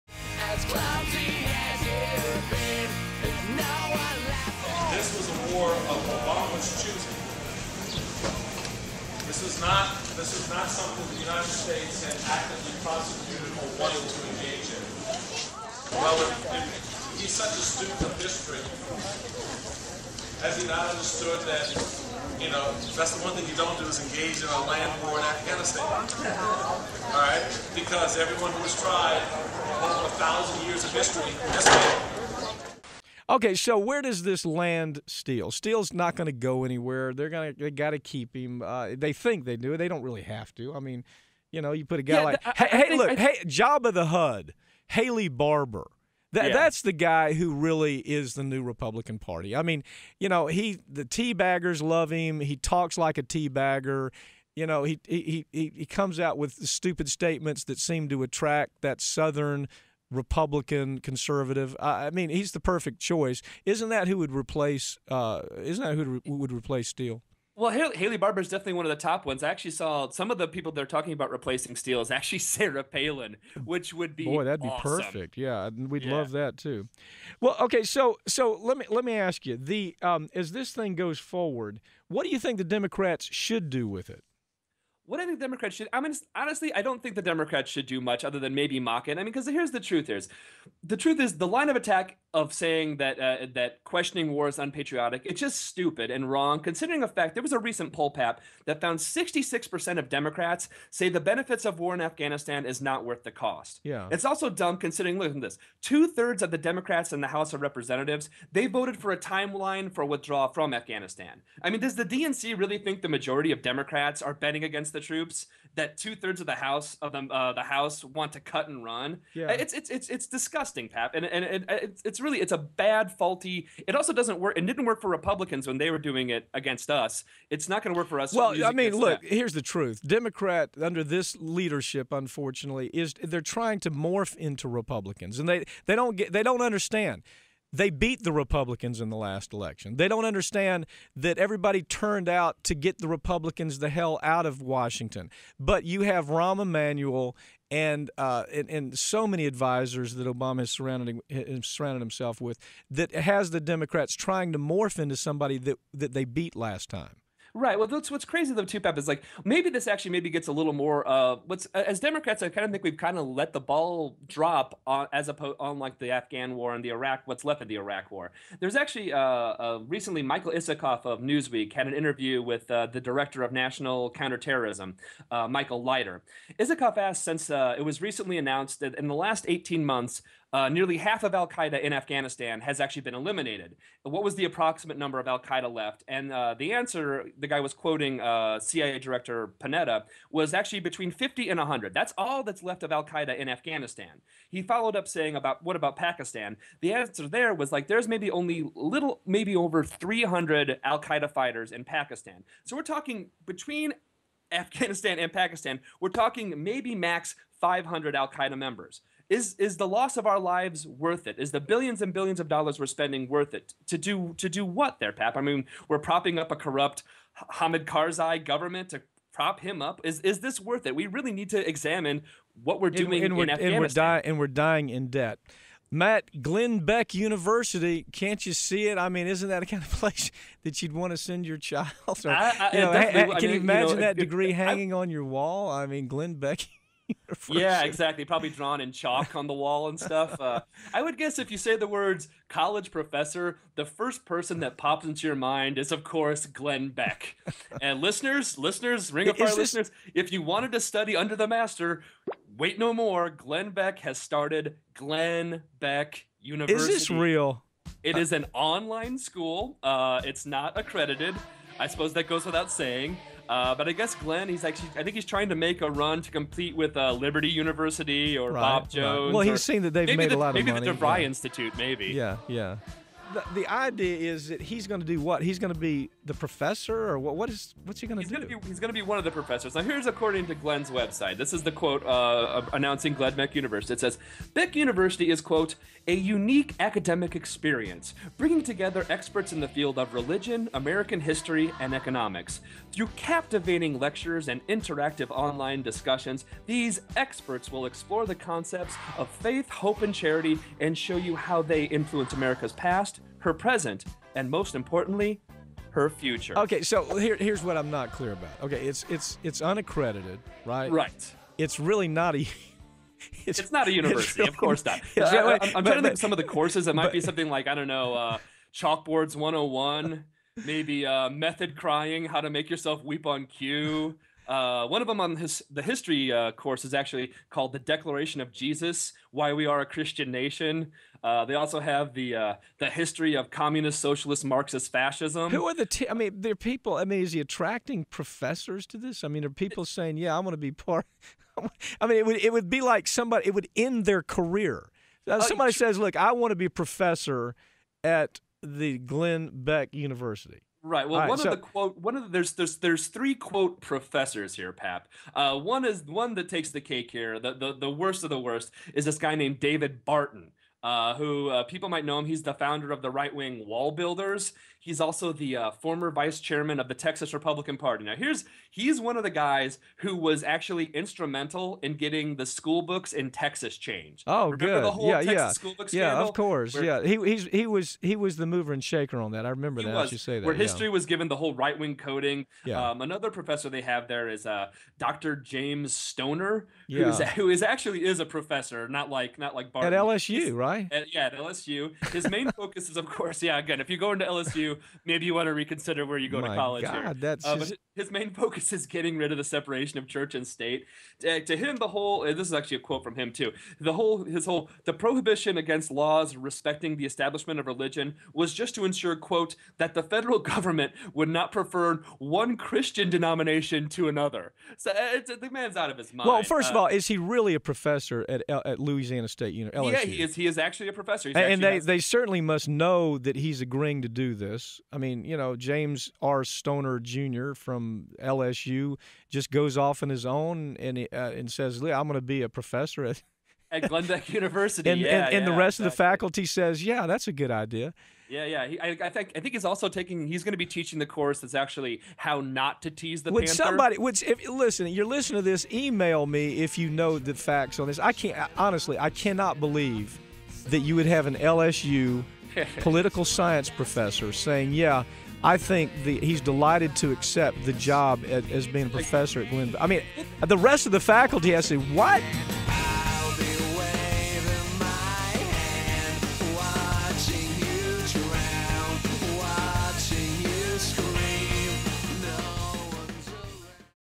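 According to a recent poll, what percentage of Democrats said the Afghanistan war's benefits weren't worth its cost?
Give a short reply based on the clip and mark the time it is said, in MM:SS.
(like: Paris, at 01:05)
66%, at 01:38.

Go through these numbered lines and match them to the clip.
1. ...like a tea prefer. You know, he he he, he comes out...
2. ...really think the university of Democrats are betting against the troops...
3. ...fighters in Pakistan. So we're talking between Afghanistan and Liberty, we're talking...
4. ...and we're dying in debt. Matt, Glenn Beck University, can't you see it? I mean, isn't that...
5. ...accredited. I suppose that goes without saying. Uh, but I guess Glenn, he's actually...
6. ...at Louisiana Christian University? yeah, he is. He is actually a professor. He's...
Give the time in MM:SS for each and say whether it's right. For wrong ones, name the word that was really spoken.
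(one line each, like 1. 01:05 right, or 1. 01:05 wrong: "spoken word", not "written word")
1. 00:52 wrong: "bagger", not "prefer"
2. 01:52 wrong: "majority", not "university"
3. 03:21 wrong: "Pakistan", not "Liberty"
4. 03:44 right
5. 04:20 right
6. 06:58 wrong: "State", not "Christian".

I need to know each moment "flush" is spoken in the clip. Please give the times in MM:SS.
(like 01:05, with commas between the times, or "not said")
not said.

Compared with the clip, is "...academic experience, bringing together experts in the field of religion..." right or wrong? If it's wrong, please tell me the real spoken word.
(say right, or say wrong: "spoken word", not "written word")
right.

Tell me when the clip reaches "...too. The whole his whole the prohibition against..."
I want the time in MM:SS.
06:43.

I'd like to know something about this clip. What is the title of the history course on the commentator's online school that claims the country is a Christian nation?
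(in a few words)
The Declaration of Jesus.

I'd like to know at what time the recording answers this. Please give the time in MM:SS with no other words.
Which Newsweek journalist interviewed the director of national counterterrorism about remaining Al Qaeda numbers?
02:50.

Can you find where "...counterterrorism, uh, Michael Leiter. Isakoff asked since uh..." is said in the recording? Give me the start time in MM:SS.
02:54.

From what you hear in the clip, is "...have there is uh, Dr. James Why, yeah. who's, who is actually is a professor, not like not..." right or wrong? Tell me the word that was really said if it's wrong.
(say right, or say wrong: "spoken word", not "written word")
wrong: "Stoner", not "Why".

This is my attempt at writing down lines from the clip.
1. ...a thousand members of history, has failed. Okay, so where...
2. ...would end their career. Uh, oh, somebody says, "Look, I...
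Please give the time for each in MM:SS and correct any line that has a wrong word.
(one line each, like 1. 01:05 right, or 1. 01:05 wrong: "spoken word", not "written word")
1. 00:30 wrong: "years", not "members"
2. 05:43 right.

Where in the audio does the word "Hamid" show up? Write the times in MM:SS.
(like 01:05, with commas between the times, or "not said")
03:37.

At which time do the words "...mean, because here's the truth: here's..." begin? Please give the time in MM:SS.
01:29.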